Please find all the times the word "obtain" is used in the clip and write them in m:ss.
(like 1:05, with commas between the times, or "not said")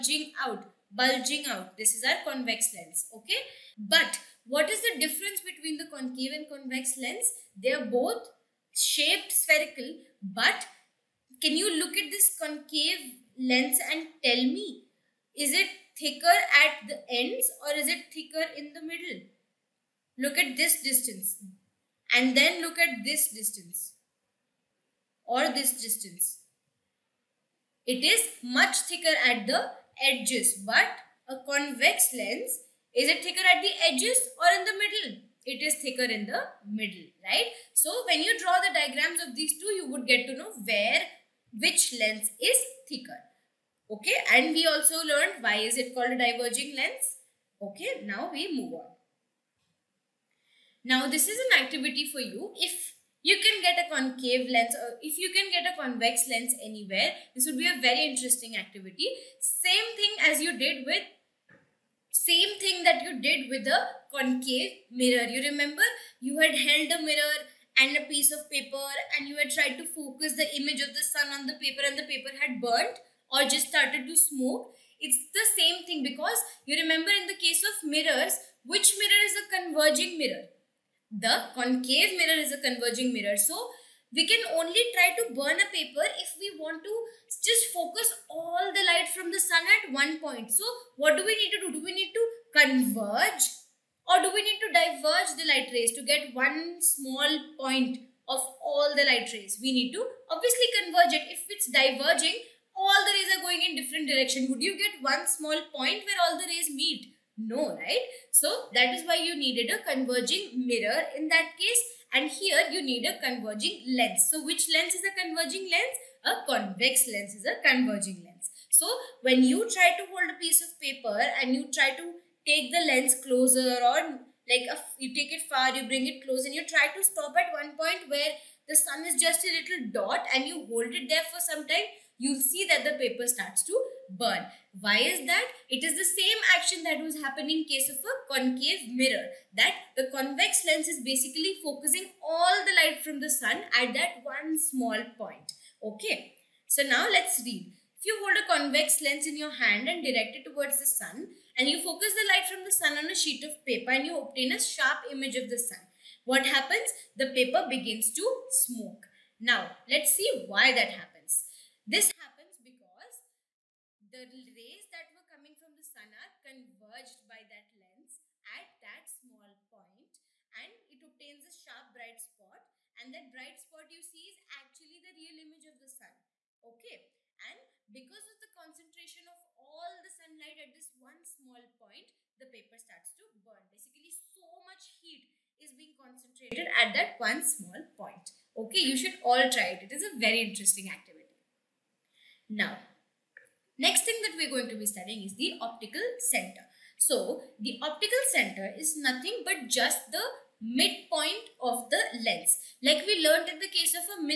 2:34, 2:51.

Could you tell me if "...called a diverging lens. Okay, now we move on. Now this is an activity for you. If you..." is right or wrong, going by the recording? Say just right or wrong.
right.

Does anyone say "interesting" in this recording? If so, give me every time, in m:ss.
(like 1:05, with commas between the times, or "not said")
0:58, 3:10.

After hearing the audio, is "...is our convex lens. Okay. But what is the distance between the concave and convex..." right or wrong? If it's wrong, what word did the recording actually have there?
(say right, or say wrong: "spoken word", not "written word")
wrong: "difference", not "distance".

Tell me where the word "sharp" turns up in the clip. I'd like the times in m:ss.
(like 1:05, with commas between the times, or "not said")
2:34, 2:51.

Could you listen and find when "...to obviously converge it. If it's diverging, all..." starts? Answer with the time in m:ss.
1:39.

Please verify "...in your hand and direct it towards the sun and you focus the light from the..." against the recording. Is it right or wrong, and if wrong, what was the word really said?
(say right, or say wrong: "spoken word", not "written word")
right.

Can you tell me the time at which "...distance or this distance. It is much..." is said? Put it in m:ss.
0:23.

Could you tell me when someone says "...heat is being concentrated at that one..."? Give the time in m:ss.
3:04.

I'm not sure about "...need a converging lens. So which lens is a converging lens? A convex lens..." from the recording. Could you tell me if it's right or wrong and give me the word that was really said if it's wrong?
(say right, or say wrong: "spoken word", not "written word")
right.